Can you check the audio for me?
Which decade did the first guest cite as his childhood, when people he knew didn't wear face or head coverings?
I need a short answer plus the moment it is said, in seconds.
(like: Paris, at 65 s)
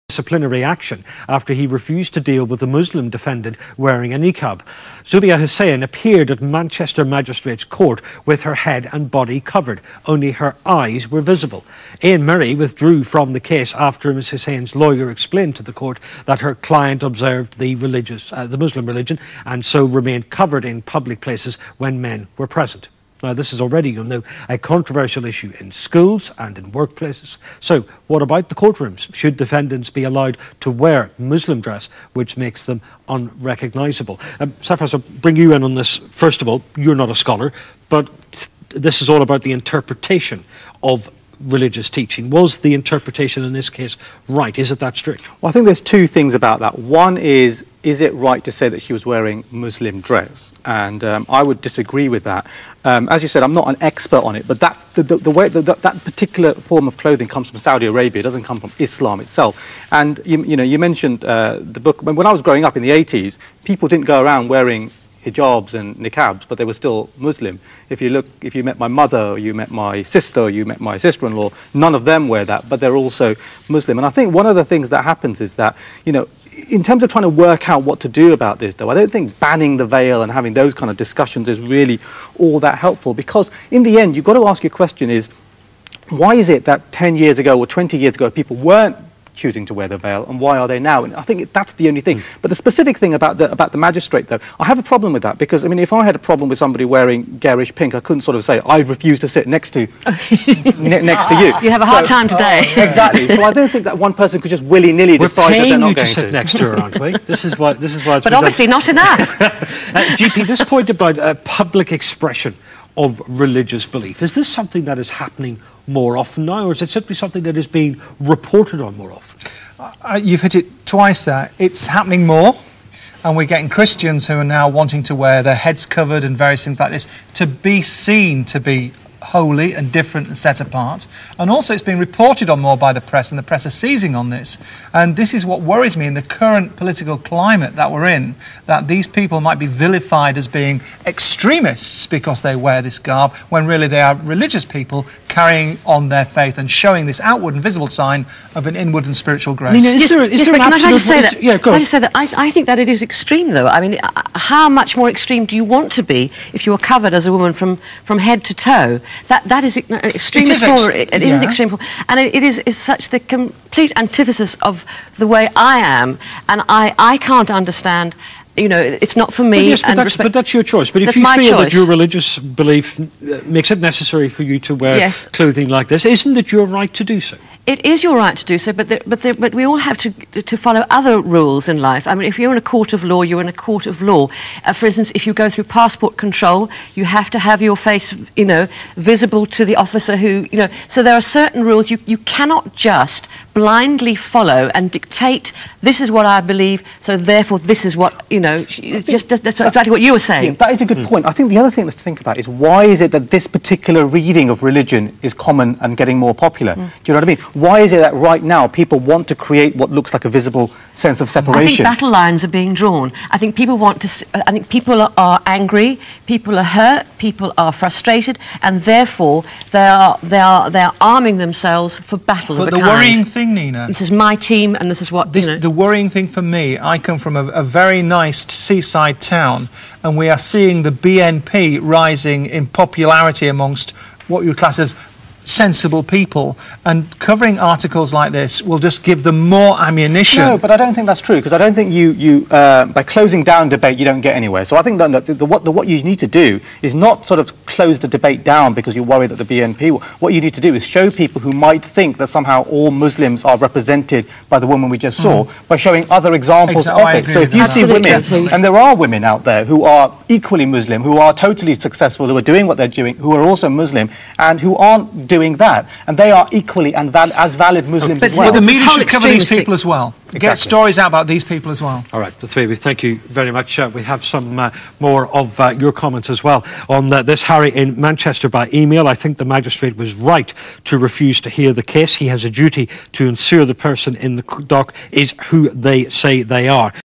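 the 80s, at 62 s.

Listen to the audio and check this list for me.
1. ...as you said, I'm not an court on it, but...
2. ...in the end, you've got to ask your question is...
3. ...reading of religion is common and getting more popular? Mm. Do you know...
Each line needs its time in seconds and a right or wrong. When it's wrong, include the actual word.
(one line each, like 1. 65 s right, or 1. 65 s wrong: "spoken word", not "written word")
1. 53 s wrong: "expert", not "court"
2. 83 s right
3. 204 s right.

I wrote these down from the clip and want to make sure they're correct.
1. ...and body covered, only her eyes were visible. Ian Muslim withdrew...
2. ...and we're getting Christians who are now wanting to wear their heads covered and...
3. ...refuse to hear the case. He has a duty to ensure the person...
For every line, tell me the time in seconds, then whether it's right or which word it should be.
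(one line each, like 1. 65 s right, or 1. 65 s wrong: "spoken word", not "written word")
1. 8 s wrong: "Murray", not "Muslim"
2. 123 s right
3. 280 s right.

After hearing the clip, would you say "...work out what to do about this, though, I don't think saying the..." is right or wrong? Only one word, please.
wrong.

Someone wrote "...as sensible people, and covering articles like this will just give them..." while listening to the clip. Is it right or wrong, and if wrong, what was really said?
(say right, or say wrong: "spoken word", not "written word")
right.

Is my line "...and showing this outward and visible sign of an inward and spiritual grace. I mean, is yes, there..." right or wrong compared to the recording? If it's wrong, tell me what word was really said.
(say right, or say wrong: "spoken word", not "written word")
right.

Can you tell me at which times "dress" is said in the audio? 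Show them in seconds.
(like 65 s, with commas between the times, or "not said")
31 s, 50 s.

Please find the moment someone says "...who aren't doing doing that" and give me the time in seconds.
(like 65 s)
264 s.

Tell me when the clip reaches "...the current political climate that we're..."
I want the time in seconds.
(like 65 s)
136 s.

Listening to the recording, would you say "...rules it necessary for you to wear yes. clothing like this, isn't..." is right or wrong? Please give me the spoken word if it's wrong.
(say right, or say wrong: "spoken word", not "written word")
wrong: "makes", not "rules".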